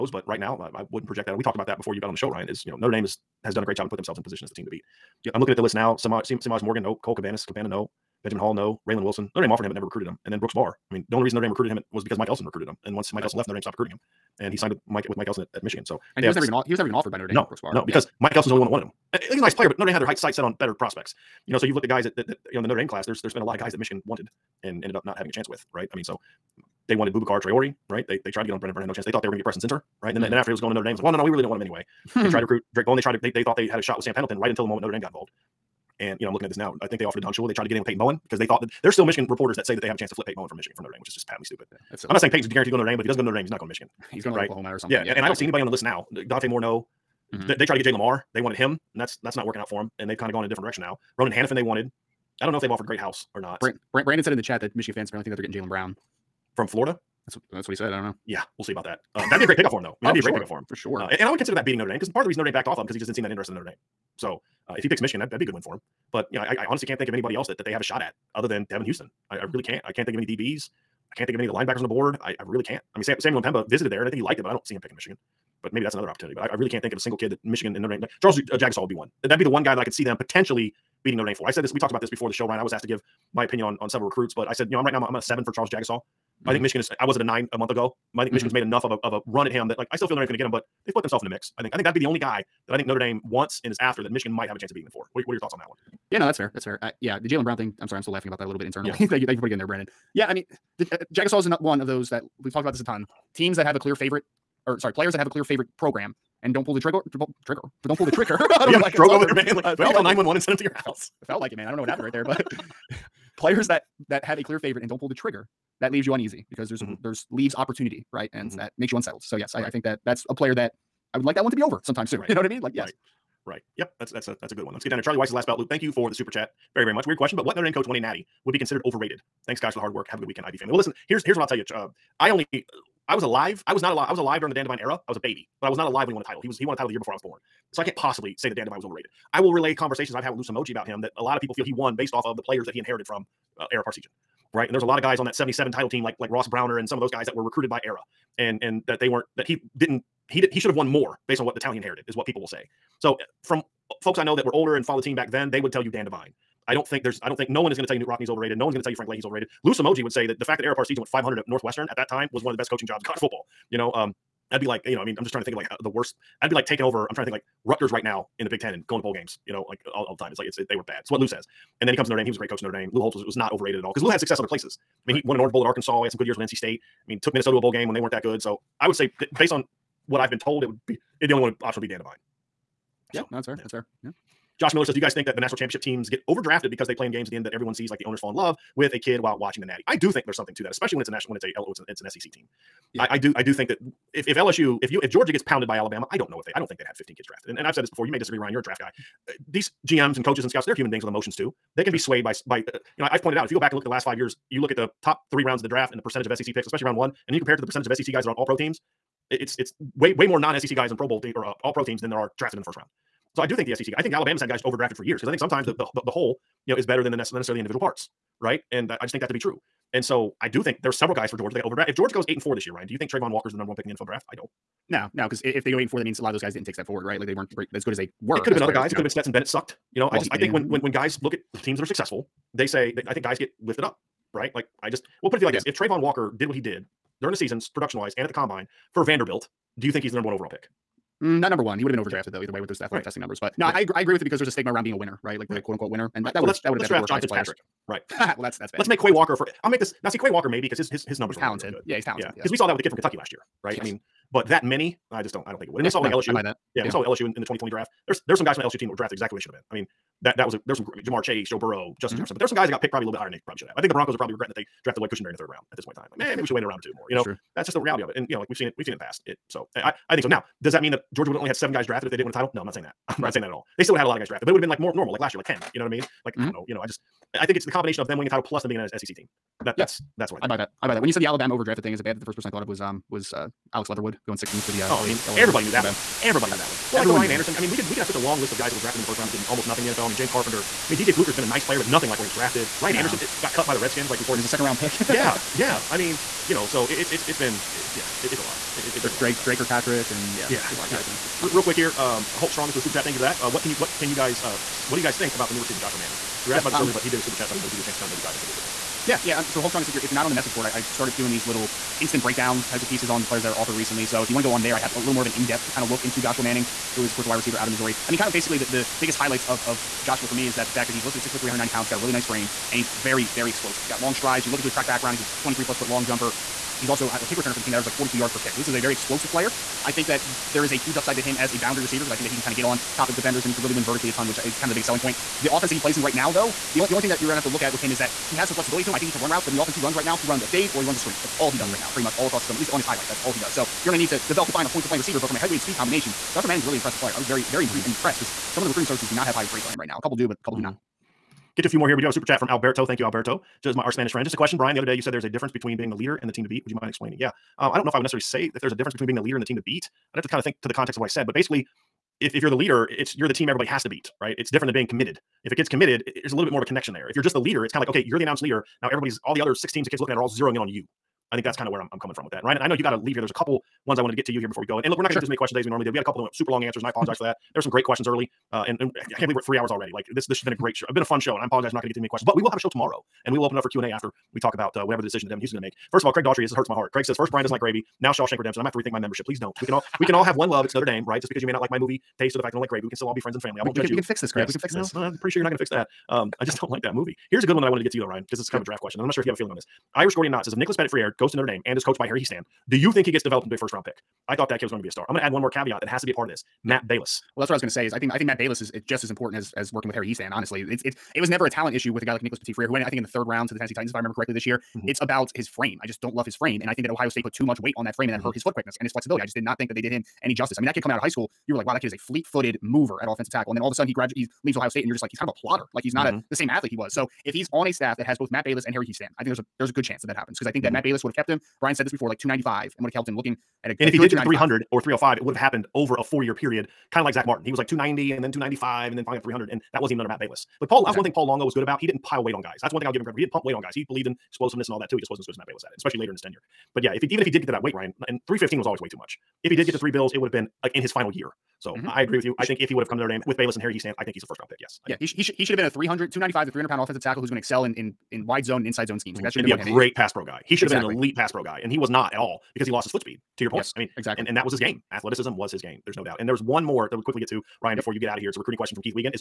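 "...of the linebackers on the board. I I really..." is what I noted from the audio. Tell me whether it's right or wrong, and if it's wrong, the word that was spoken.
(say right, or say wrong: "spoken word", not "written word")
right.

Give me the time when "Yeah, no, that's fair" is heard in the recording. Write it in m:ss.
1:36.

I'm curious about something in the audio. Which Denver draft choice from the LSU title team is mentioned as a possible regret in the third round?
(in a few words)
Lloyd Cushenberry.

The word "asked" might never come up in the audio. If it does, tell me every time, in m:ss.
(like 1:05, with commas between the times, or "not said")
1:22, 5:06.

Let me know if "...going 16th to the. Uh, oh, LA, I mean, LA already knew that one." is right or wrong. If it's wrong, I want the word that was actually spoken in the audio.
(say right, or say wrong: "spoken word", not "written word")
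wrong: "everybody", not "already".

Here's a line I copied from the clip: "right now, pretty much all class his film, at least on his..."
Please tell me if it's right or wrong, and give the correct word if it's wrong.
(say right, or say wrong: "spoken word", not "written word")
wrong: "across", not "class".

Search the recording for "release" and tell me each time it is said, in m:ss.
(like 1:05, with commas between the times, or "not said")
not said.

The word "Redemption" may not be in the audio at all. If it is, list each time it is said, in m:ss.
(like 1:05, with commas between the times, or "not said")
6:28.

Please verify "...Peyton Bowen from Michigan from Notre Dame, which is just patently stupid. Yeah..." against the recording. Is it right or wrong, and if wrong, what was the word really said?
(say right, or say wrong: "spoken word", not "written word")
right.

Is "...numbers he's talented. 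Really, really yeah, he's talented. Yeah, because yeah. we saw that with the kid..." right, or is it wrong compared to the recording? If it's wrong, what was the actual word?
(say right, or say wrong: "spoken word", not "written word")
right.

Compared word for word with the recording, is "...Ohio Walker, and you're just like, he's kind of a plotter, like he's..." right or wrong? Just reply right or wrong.
wrong.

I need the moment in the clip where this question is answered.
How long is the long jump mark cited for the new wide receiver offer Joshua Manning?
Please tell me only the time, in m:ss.
5:25.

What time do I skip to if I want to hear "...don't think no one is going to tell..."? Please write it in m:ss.
2:37.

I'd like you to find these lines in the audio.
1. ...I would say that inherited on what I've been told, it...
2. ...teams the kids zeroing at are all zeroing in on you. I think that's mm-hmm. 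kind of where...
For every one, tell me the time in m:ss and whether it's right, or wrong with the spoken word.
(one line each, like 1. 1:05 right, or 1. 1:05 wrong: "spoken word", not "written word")
1. 2:58 wrong: "based", not "inherited"
2. 6:09 wrong: "looking", not "zeroing".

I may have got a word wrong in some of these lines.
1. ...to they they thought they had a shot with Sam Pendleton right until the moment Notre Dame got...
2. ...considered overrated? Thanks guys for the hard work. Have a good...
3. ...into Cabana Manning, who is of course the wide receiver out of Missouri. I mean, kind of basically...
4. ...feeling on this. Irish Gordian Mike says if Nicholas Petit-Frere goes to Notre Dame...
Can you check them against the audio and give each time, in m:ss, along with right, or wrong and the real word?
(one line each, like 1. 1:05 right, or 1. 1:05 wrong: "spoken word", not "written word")
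1. 0:33 right
2. 2:08 right
3. 5:16 wrong: "Joshua", not "Cabana"
4. 6:39 wrong: "Knott", not "Mike".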